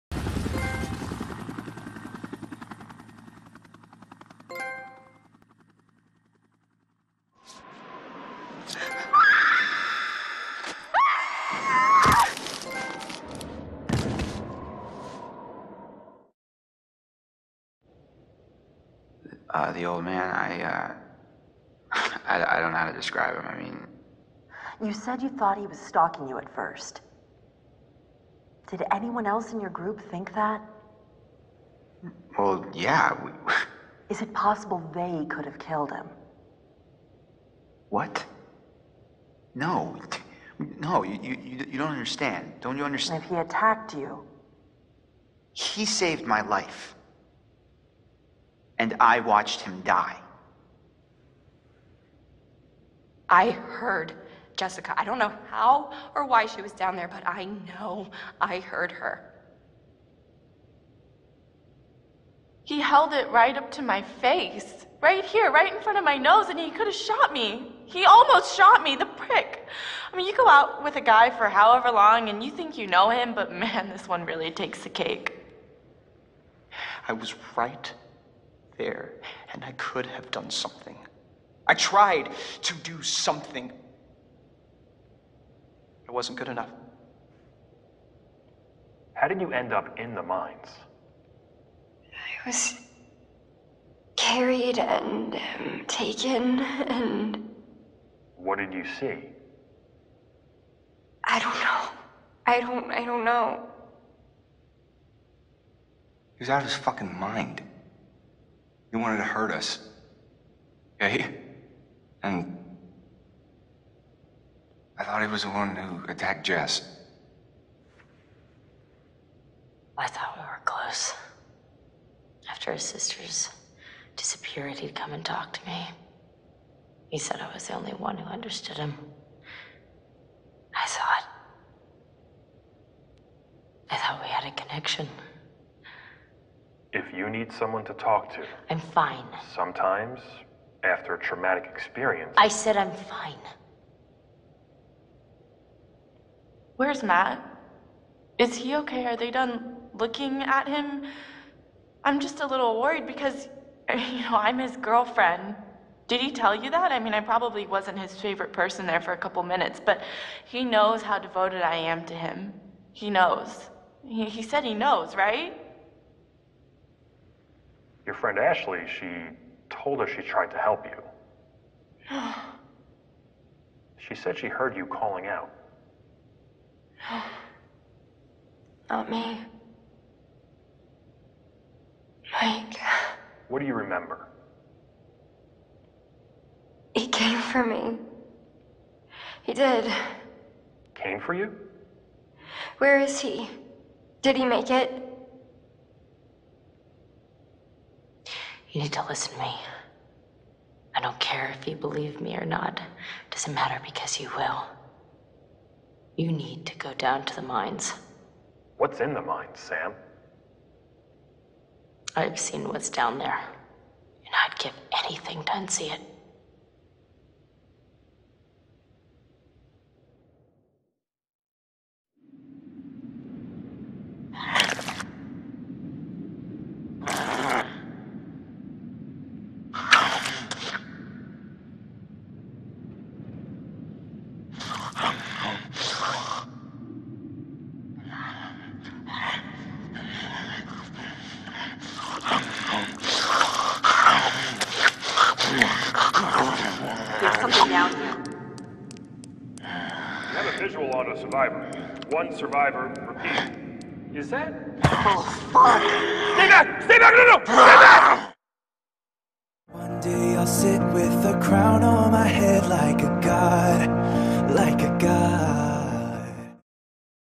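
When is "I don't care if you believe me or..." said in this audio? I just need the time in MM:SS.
03:20.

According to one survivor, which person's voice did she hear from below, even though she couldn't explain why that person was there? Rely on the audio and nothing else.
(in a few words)
Jessica.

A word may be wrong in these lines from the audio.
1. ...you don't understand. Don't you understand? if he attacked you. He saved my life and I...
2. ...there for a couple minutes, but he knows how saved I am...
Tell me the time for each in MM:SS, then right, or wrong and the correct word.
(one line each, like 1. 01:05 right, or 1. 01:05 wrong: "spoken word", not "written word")
1. 00:41 right
2. 02:38 wrong: "devoted", not "saved".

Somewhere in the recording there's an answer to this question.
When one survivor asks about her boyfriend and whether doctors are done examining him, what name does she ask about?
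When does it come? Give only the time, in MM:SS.
02:27.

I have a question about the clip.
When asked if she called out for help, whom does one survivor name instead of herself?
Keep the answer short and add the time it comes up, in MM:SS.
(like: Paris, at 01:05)
Mike, at 03:02.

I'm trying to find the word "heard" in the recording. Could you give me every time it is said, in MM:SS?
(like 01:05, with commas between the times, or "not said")
00:53, 00:58, 02:54.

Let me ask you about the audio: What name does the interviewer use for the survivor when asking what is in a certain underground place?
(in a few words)
Sam.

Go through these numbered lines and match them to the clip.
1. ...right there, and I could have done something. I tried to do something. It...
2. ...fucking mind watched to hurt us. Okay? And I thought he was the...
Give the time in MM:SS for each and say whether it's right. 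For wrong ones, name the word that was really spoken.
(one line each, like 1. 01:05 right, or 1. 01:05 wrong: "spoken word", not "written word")
1. 01:17 right
2. 01:46 wrong: "wanted", not "watched".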